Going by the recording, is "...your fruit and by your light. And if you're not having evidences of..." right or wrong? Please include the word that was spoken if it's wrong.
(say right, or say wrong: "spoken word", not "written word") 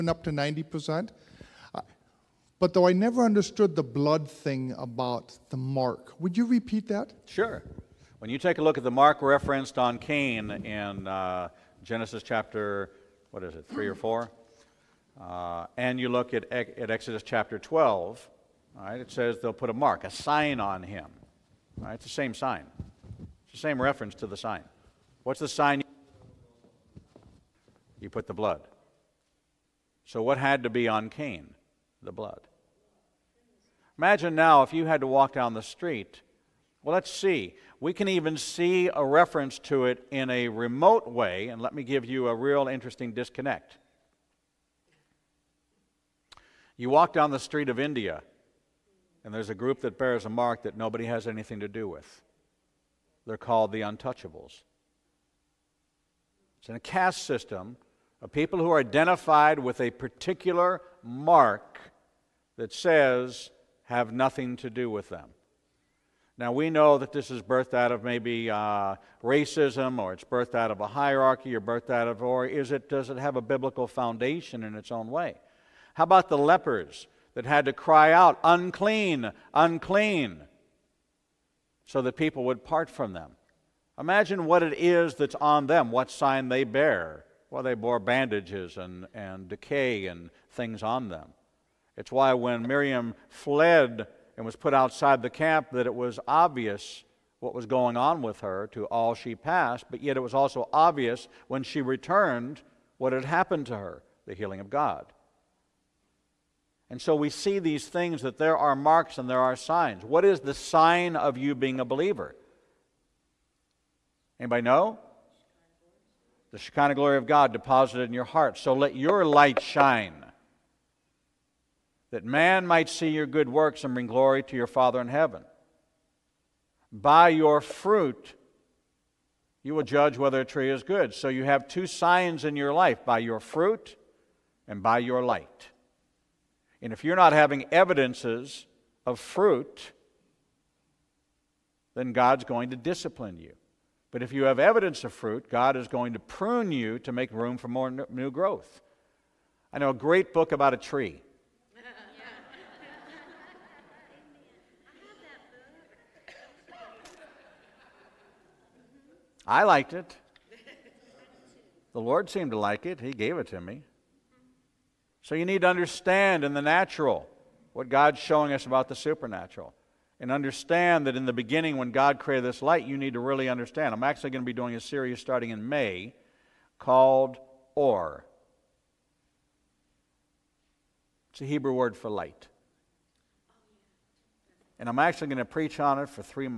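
right.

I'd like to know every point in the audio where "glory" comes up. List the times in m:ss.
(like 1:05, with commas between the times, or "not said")
1:56, 2:04.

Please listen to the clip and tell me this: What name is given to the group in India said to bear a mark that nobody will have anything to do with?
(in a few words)
The untouchables.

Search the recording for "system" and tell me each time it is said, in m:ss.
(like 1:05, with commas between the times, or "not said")
0:57.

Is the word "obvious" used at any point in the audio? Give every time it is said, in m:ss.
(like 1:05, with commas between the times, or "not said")
1:36, 1:40.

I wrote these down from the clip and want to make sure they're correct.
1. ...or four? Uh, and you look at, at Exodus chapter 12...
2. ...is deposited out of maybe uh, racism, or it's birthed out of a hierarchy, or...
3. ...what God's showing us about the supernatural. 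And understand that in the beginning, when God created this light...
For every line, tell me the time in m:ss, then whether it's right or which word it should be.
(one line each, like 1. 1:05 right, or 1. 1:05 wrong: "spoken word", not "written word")
1. 0:13 right
2. 1:07 wrong: "birthed", not "deposited"
3. 2:47 right.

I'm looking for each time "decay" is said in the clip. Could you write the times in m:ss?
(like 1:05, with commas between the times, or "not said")
1:29.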